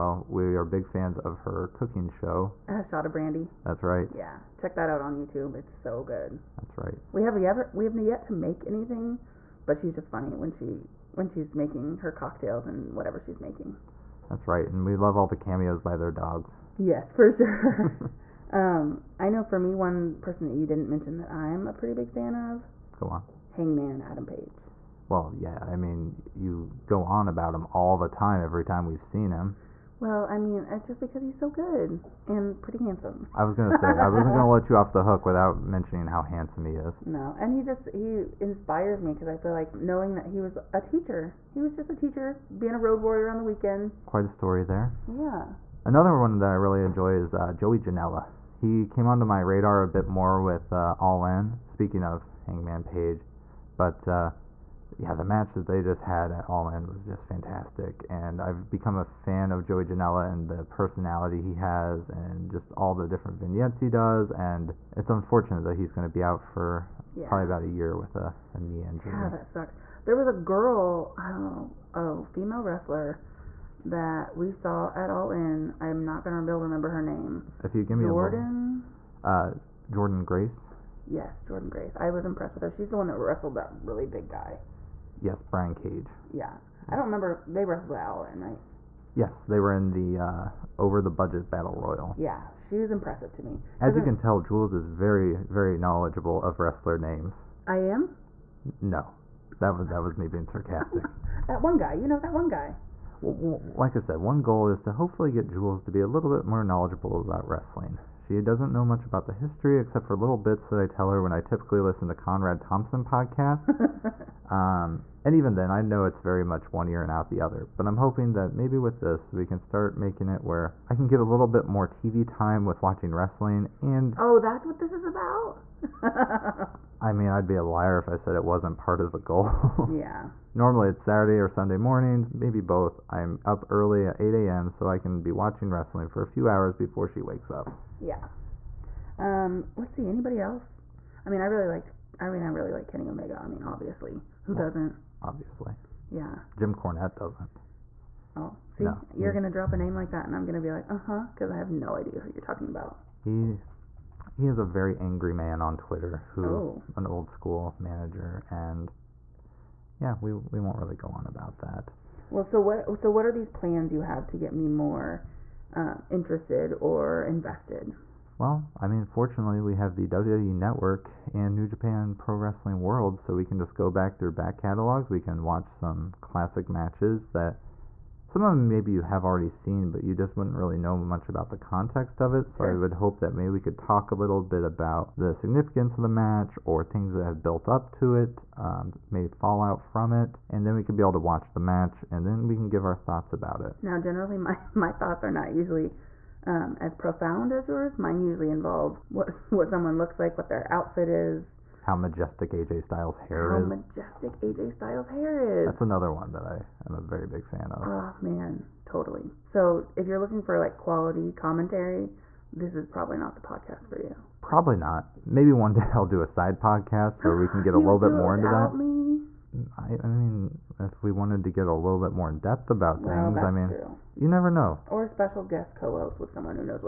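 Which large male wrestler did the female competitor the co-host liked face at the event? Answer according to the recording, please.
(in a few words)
Brian Cage.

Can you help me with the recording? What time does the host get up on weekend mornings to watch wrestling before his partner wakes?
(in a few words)
8 a.m.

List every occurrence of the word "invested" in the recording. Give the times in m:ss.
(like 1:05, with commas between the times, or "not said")
2:47.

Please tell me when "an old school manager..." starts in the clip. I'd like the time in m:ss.
2:36.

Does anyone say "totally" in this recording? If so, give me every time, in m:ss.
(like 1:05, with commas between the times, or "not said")
3:28.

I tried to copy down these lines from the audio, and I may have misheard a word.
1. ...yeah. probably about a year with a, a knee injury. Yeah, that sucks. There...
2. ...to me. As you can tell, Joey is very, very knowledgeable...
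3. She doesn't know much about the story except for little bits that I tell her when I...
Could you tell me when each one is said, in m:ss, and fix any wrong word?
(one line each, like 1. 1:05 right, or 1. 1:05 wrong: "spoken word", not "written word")
1. 1:07 right
2. 1:33 wrong: "Jules", not "Joey"
3. 1:48 wrong: "history", not "story".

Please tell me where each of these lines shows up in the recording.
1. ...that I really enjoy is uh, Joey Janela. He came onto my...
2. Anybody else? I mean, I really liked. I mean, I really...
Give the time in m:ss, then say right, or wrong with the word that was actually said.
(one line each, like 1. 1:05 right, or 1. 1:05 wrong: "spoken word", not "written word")
1. 0:46 right
2. 2:20 right.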